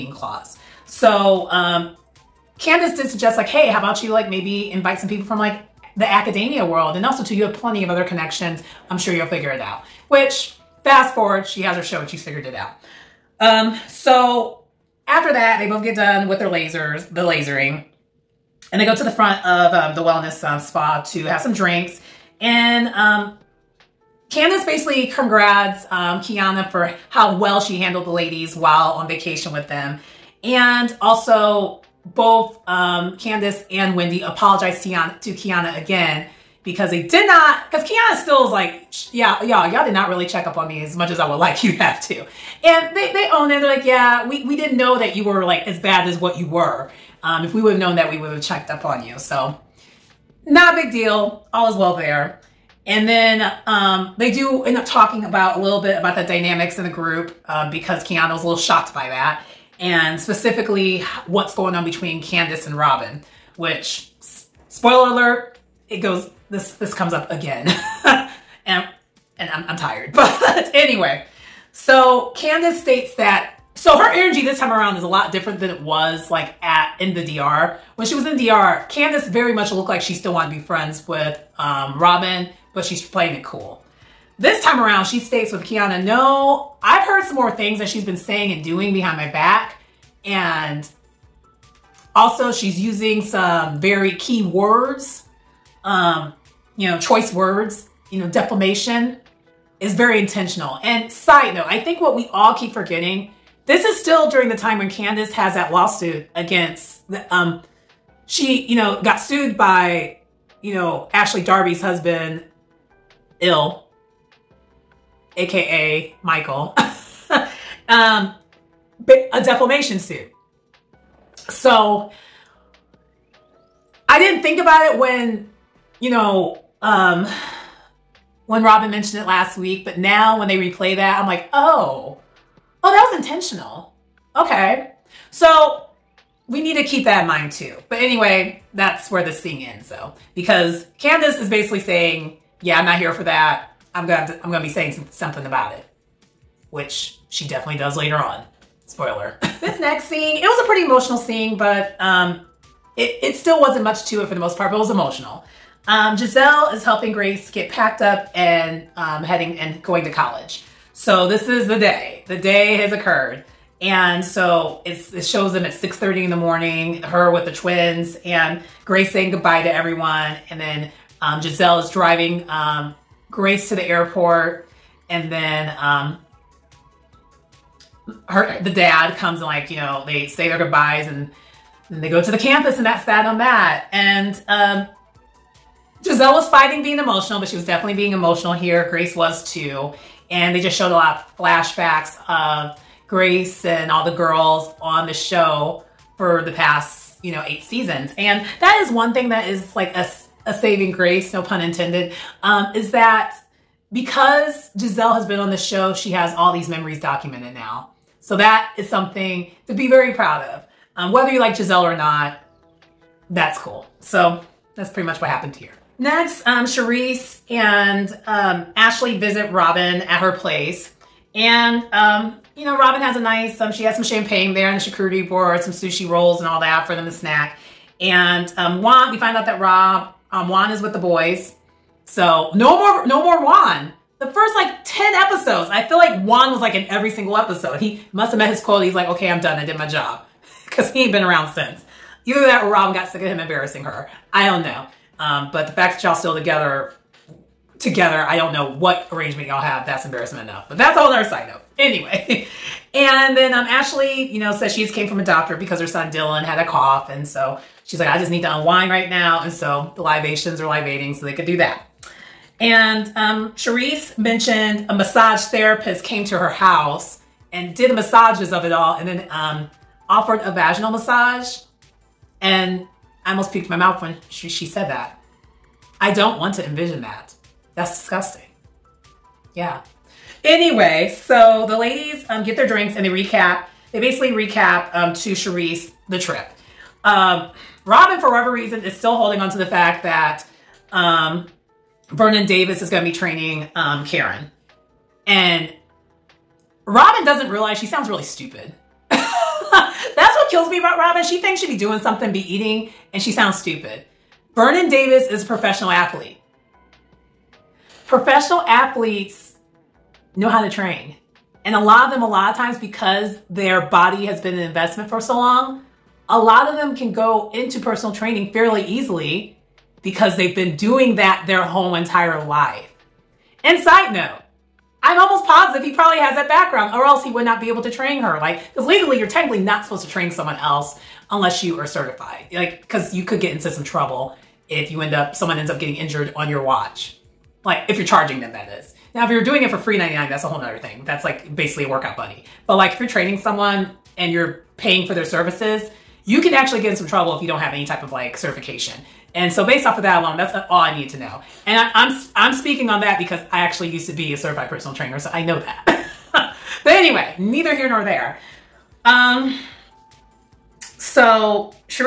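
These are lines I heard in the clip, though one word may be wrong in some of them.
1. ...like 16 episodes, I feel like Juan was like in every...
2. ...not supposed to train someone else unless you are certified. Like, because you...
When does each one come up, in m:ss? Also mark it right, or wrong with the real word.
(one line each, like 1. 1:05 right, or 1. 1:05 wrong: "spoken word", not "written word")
1. 3:54 wrong: "10", not "16"
2. 5:29 right.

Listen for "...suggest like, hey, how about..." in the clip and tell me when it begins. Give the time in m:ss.
0:03.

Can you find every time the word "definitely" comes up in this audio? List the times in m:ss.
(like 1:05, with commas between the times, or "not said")
2:27, 3:07.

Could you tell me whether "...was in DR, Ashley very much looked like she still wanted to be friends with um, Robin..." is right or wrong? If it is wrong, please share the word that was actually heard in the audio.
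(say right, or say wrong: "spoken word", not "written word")
wrong: "Candace", not "Ashley".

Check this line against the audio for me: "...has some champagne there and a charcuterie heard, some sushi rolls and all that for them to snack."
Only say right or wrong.
wrong.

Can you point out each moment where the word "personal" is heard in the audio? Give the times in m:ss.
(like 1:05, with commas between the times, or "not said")
5:17, 5:54.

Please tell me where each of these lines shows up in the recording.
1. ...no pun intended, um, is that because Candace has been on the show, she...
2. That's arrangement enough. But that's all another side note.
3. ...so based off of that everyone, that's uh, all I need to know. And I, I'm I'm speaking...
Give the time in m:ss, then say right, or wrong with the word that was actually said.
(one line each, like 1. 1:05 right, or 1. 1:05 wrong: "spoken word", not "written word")
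1. 3:21 wrong: "Giselle", not "Candace"
2. 4:09 wrong: "embarrassment", not "arrangement"
3. 5:49 wrong: "alone", not "everyone".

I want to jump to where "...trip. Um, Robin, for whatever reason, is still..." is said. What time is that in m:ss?
4:46.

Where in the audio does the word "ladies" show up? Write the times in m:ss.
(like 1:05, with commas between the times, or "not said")
0:28, 4:41.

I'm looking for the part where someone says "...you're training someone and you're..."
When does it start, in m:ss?
5:42.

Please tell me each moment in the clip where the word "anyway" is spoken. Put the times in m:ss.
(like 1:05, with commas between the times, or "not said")
1:10, 2:17, 4:11, 4:40, 5:56.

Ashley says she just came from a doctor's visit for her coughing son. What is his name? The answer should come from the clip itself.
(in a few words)
Dylan.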